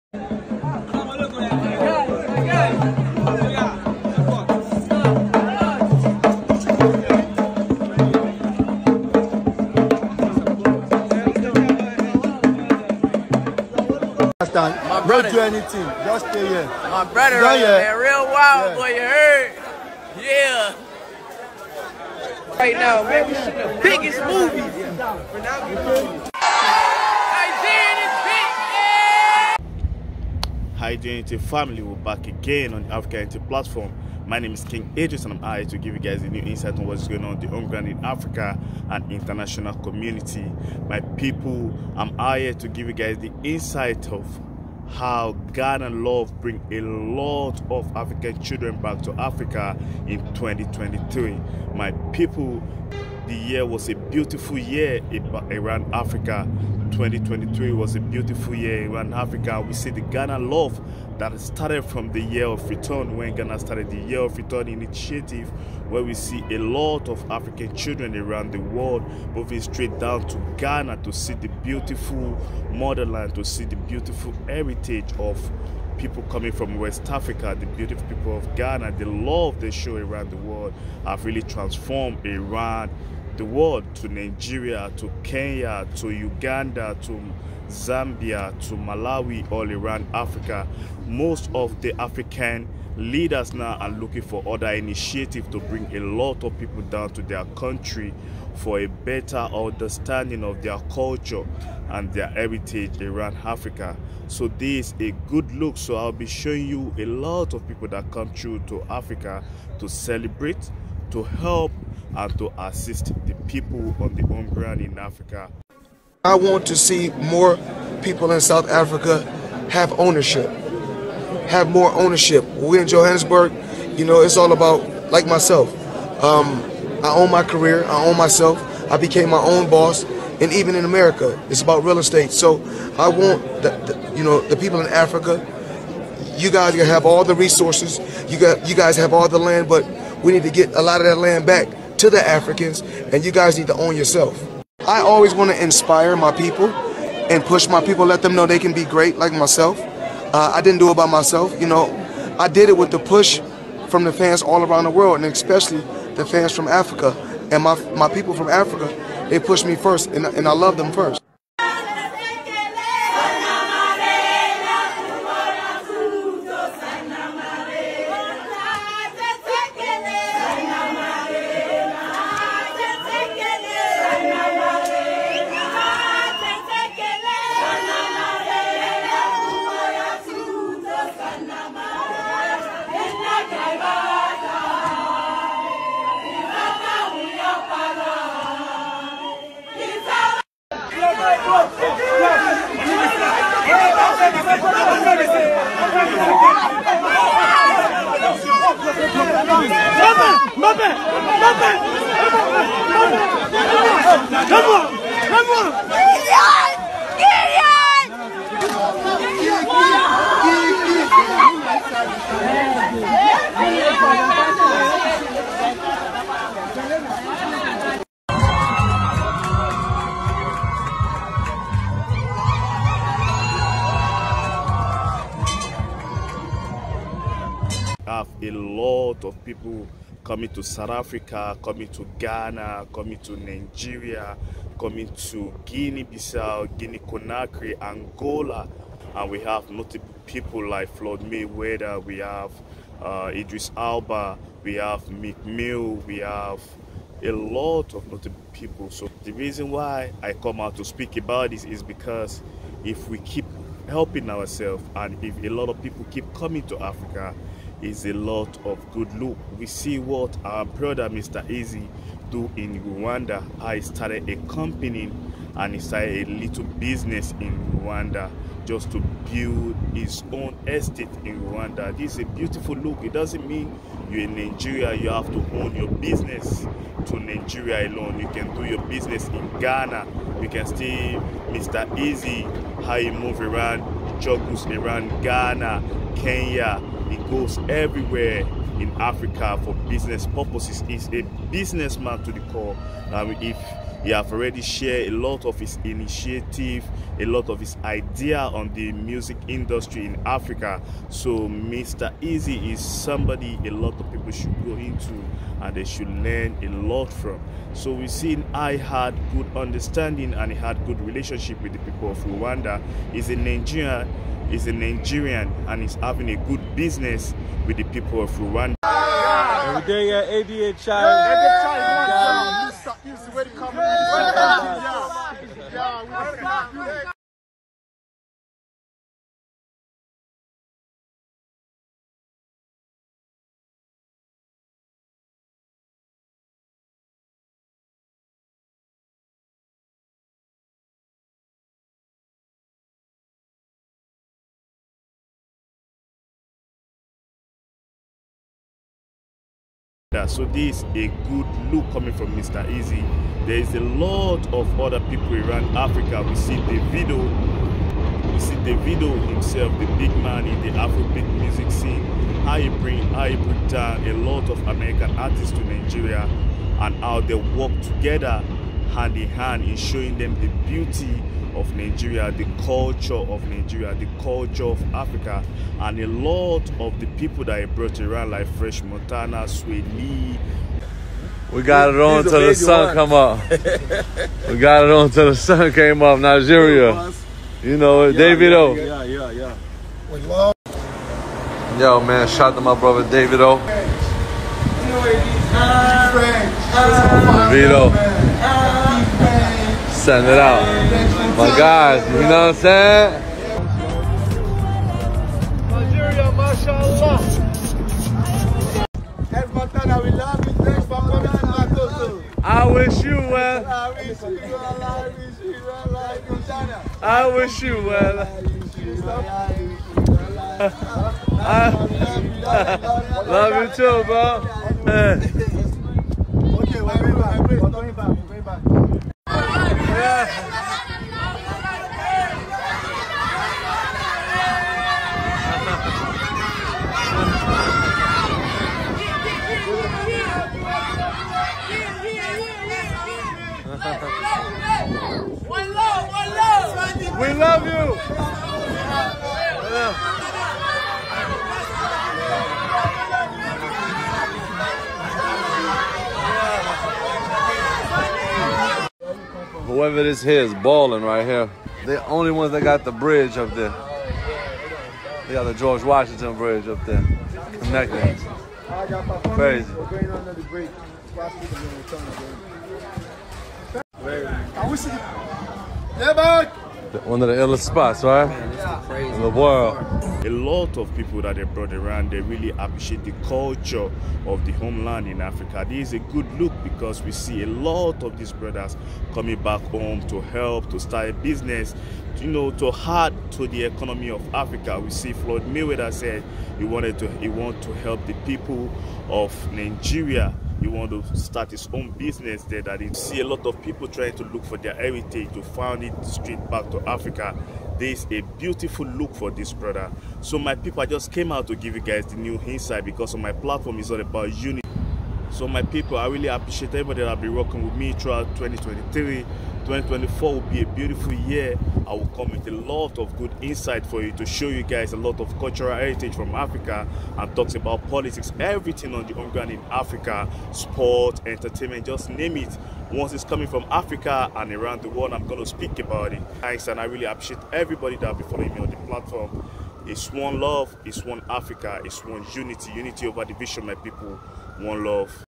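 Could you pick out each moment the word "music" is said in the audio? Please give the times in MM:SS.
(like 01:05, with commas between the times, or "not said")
04:58, 06:01.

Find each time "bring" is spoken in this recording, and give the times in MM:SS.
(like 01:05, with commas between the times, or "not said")
00:46, 01:35, 06:02.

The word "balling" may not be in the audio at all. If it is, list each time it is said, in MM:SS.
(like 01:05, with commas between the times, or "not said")
07:40.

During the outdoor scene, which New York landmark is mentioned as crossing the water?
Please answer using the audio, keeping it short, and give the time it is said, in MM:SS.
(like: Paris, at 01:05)
George Washington Bridge, at 07:45.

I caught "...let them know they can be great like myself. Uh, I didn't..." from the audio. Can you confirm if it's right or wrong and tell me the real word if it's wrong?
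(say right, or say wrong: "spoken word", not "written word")
right.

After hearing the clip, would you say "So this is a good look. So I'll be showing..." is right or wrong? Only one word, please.
right.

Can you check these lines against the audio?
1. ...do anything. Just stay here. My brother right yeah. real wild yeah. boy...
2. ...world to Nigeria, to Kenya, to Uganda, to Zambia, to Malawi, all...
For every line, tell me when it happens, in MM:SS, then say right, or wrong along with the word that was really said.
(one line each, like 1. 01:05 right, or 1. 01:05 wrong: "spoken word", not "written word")
1. 00:15 right
2. 01:23 right.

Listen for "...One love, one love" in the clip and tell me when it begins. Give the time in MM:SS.
07:23.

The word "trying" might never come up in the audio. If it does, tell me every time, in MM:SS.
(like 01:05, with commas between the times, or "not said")
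08:23.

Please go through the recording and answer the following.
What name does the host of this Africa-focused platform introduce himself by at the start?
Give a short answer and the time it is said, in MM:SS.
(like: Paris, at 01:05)
King Idris, at 00:34.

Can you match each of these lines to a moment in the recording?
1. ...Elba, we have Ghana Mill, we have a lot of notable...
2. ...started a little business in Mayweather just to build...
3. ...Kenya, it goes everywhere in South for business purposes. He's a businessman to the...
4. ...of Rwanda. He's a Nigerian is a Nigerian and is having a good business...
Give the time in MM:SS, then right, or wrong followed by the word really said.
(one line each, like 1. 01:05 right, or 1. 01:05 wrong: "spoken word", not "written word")
1. 04:03 wrong: "Meek", not "Ghana"
2. 04:25 wrong: "Rwanda", not "Mayweather"
3. 04:46 wrong: "Africa", not "South"
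4. 05:12 right.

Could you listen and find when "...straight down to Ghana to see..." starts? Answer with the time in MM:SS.
01:09.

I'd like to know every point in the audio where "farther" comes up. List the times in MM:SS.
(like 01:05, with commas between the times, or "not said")
not said.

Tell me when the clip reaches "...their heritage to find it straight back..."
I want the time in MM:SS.
08:24.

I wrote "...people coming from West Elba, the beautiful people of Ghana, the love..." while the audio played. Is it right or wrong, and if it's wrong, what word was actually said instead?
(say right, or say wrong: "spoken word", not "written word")
wrong: "Africa", not "Elba".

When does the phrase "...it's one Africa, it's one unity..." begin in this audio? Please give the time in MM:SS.
09:00.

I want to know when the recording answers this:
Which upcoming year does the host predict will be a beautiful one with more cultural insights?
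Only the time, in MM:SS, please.
08:39.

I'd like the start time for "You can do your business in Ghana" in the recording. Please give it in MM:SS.
04:38.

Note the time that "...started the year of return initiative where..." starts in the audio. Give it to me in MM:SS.
01:03.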